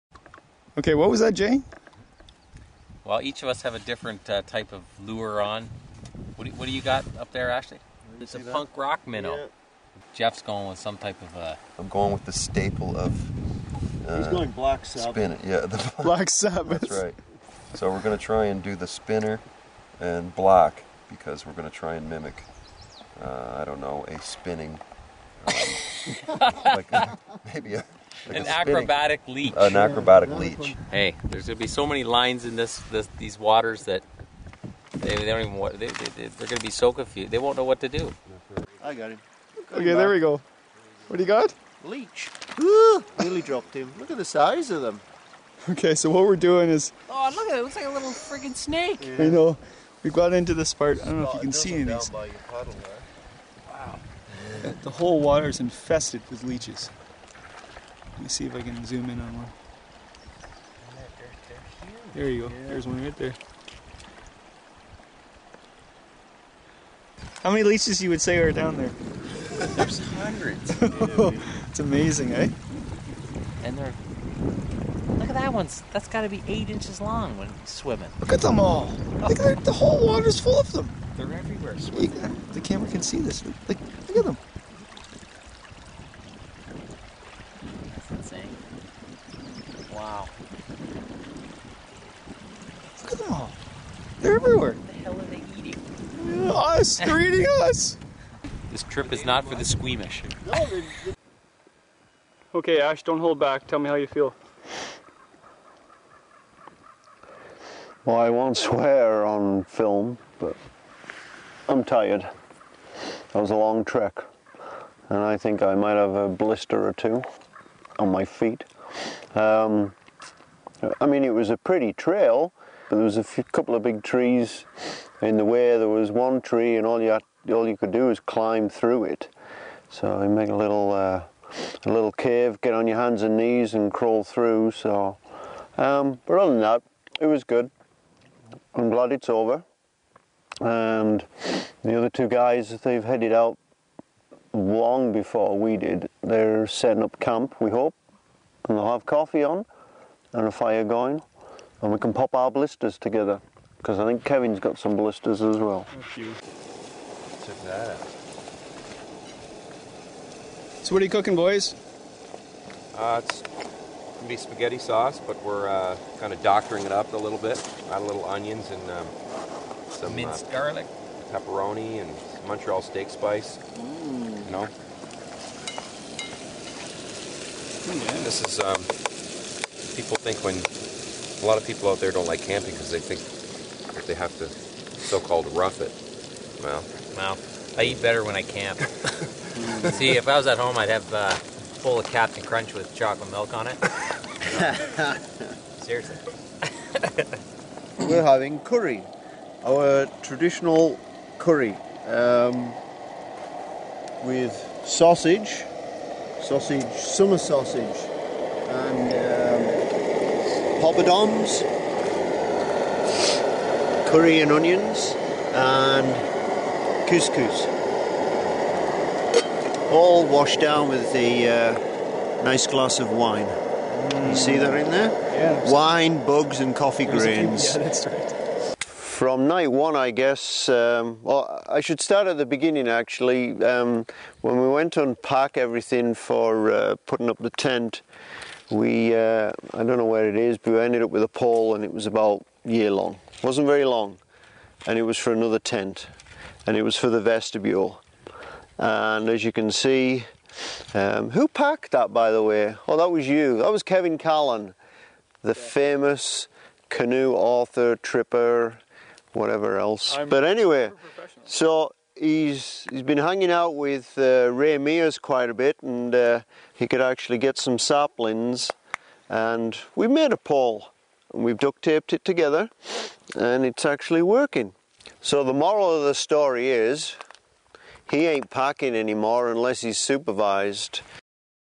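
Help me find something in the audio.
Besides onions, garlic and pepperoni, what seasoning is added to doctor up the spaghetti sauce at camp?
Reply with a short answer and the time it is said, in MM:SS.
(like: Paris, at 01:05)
Montreal steak spice, at 02:52.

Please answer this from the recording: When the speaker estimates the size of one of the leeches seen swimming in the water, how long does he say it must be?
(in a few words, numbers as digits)
8 inches.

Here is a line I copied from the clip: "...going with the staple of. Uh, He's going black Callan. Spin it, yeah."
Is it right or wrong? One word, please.
wrong.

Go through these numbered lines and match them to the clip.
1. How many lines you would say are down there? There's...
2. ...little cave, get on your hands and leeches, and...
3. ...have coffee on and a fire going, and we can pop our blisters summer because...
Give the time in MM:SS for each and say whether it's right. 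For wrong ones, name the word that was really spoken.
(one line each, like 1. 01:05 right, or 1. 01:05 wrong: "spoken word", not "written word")
1. 01:07 wrong: "leeches", not "lines"
2. 02:11 wrong: "knees", not "leeches"
3. 02:28 wrong: "together", not "summer".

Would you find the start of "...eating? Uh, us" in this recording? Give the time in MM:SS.
01:35.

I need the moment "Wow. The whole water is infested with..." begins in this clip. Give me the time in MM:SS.
00:52.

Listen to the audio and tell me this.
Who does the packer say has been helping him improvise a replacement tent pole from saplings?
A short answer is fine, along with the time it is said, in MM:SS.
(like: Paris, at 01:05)
Ray Mears, at 04:24.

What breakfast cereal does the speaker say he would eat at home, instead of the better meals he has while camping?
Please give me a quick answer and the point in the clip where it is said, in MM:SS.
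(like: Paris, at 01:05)
Captain Crunch, at 03:12.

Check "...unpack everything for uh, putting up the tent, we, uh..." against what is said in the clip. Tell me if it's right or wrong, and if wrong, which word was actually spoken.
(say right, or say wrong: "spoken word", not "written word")
right.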